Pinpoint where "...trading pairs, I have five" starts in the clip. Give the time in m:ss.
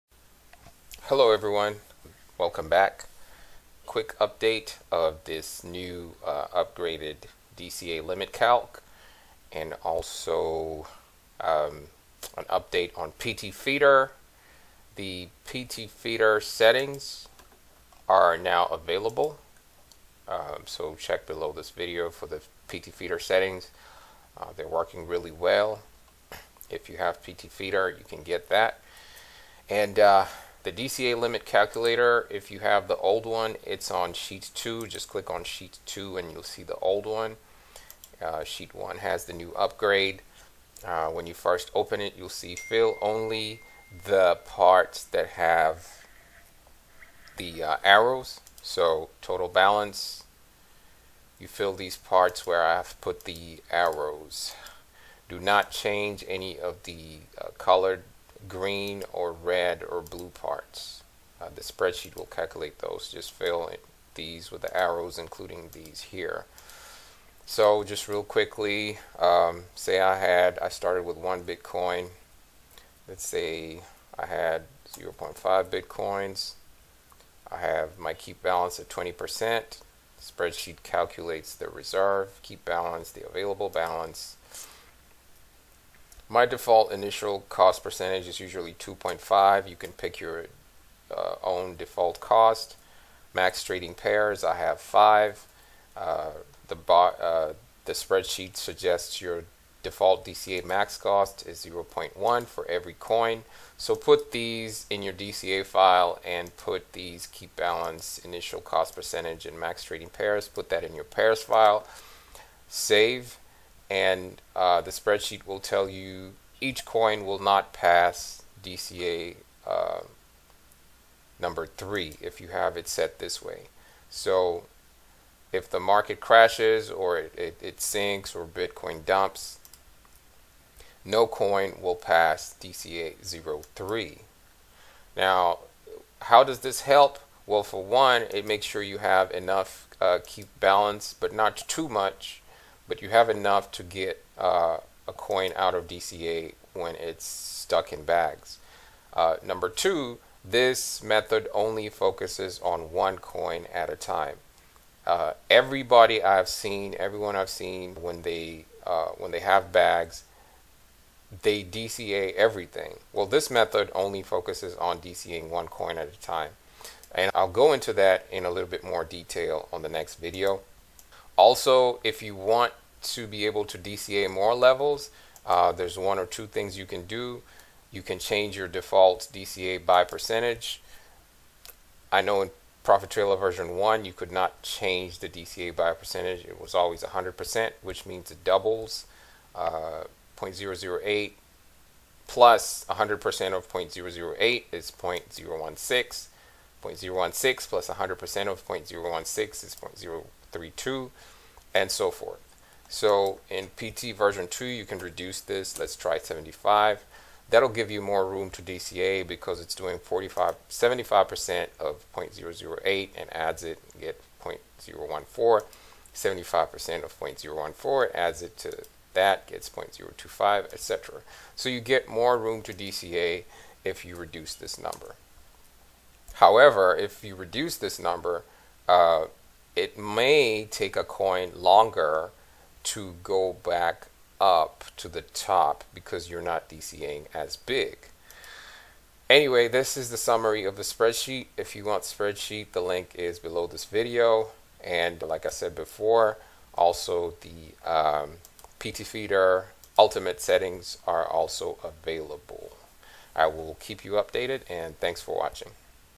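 1:33.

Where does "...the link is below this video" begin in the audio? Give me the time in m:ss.
4:02.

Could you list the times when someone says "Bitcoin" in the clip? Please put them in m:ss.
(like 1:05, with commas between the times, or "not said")
1:11, 1:15, 2:08.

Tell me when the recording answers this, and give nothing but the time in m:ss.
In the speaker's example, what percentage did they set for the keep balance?
1:18.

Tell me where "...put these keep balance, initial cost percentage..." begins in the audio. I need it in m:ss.
1:46.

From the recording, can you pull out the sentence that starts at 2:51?
Also, if you want to be able to DCA more levels, uh, there's one or two things you can do.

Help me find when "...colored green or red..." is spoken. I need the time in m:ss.
0:57.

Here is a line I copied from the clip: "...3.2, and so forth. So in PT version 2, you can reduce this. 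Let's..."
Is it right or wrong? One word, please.
right.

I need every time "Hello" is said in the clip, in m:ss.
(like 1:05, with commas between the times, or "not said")
0:01.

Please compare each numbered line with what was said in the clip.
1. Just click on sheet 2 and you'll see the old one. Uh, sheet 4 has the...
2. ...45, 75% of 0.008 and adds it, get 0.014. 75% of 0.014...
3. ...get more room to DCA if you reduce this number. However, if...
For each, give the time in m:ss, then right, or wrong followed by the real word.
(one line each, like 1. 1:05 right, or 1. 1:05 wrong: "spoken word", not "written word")
1. 0:34 wrong: "1", not "4"
2. 3:29 right
3. 3:41 right.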